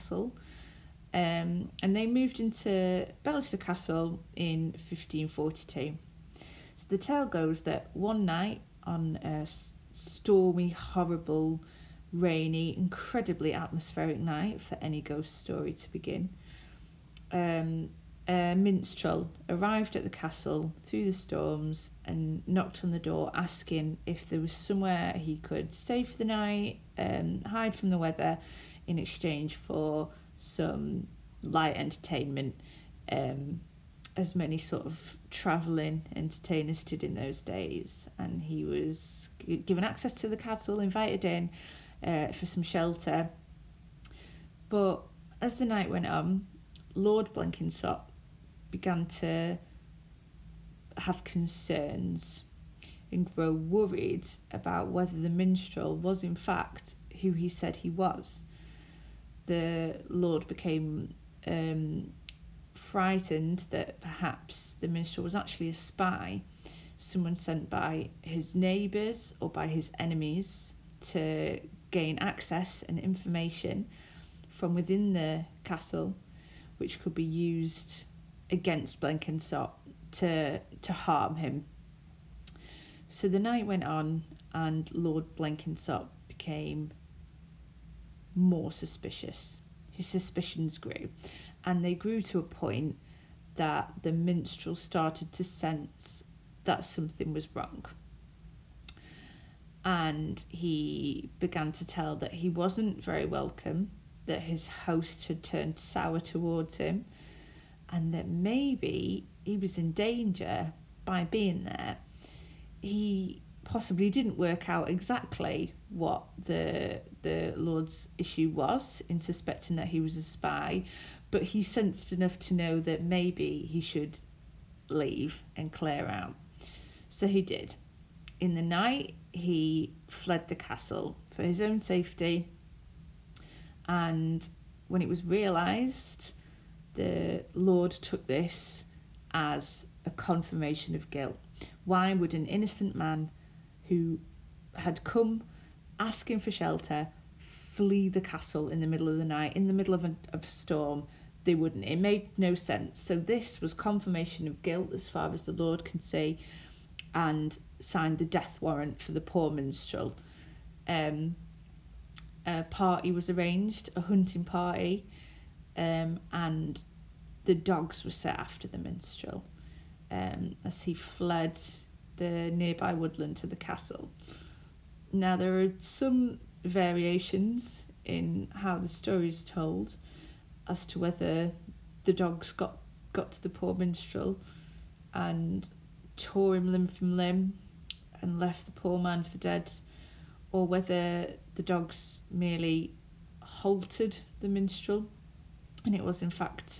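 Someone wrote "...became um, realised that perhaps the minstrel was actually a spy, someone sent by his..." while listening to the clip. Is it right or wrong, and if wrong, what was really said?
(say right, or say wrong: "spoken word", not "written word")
wrong: "frightened", not "realised".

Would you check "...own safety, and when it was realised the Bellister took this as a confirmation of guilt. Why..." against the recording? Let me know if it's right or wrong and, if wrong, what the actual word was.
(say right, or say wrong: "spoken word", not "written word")
wrong: "Lord", not "Bellister".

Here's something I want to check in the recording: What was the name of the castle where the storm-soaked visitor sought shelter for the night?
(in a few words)
Bellister Castle.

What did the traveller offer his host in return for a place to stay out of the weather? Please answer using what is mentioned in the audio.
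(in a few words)
light entertainment.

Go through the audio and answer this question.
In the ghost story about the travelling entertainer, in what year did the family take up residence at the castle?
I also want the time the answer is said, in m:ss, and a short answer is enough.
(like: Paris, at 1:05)
1542, at 0:04.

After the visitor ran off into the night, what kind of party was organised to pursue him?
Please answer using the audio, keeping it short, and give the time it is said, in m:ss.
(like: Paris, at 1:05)
A hunting party, at 2:43.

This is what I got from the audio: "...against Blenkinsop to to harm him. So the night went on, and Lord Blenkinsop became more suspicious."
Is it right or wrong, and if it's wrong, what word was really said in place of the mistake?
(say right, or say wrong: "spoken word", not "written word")
right.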